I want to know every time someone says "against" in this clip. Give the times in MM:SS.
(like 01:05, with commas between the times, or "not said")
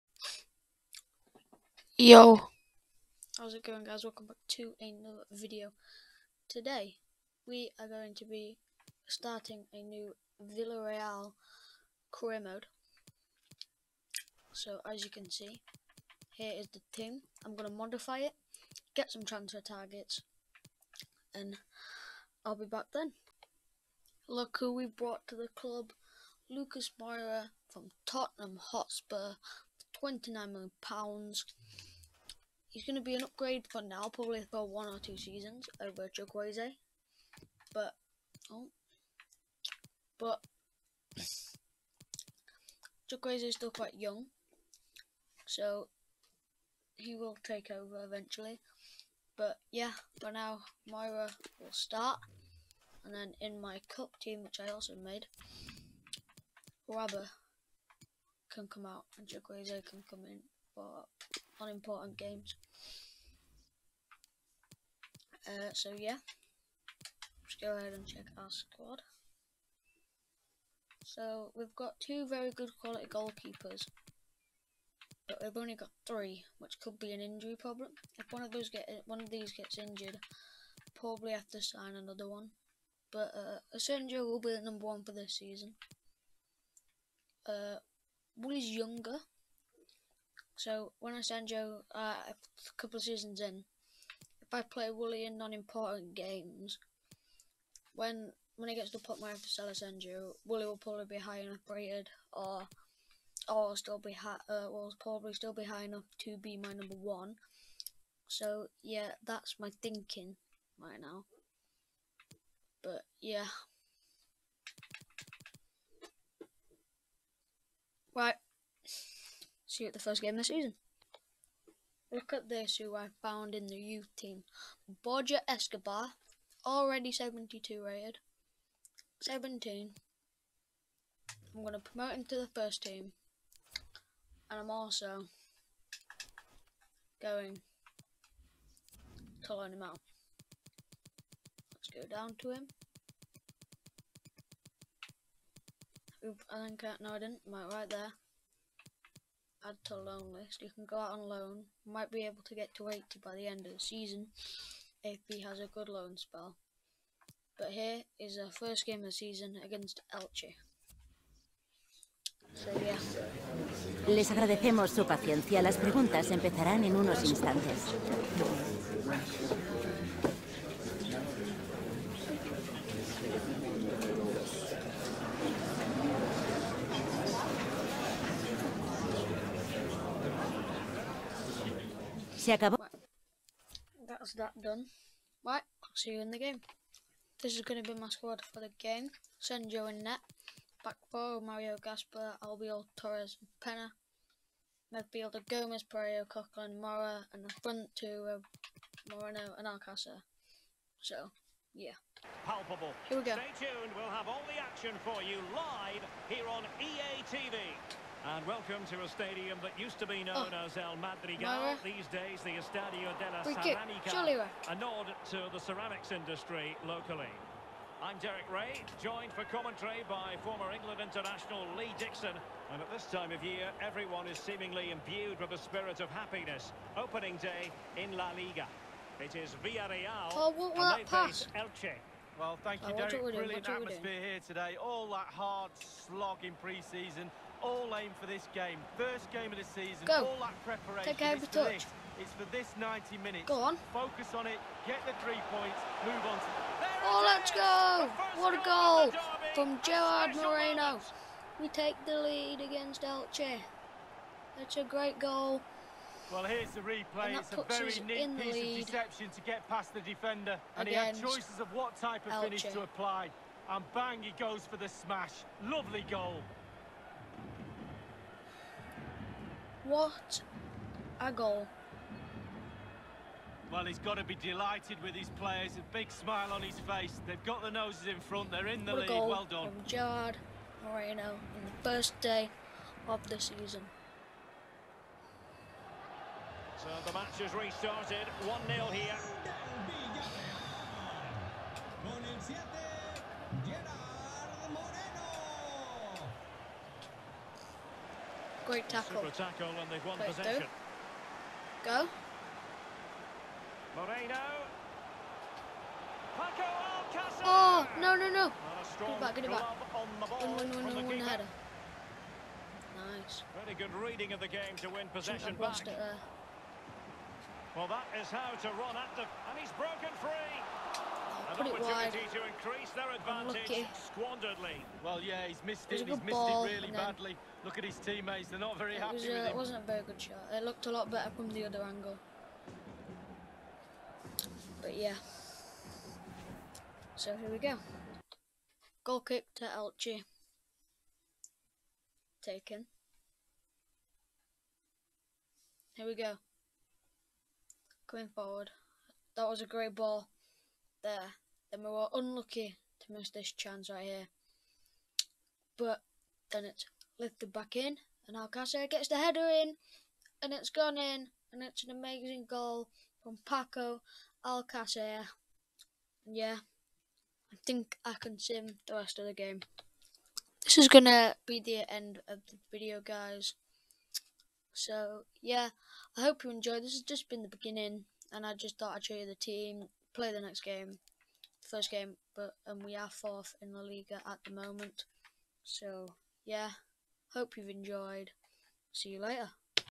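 02:39, 04:12.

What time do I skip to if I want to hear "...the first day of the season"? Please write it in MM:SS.
04:41.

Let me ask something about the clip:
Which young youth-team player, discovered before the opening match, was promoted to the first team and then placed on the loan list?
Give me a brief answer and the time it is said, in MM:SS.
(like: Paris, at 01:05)
Borja Escobar, at 02:05.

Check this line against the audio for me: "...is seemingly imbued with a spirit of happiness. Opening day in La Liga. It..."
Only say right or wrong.
right.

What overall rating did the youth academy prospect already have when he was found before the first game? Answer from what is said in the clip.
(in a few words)
72.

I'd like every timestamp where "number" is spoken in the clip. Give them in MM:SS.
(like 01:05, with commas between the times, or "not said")
01:24, 01:46.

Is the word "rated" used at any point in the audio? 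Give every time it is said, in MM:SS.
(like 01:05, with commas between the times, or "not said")
01:41, 02:07.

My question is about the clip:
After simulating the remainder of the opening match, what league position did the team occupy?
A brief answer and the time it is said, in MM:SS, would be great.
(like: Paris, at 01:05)
4th, at 06:23.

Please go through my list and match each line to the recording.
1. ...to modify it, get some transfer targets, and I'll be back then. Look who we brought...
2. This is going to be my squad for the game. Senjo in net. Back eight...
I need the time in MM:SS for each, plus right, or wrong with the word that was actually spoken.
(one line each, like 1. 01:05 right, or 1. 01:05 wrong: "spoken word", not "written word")
1. 00:17 right
2. 03:07 wrong: "four", not "eight".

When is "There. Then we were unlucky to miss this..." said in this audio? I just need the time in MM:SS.
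05:51.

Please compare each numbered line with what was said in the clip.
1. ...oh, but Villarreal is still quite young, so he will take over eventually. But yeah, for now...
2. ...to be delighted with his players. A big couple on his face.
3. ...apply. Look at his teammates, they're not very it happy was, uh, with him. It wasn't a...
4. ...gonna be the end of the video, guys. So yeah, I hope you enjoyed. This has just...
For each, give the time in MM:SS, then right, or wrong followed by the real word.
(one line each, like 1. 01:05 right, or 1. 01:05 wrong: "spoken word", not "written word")
1. 00:38 wrong: "Chukwueze", not "Villarreal"
2. 04:34 wrong: "smile", not "couple"
3. 05:26 wrong: "badly", not "apply"
4. 06:10 right.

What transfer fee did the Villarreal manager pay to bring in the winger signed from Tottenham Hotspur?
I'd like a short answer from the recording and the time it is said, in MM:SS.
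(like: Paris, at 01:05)
£29 million, at 00:30.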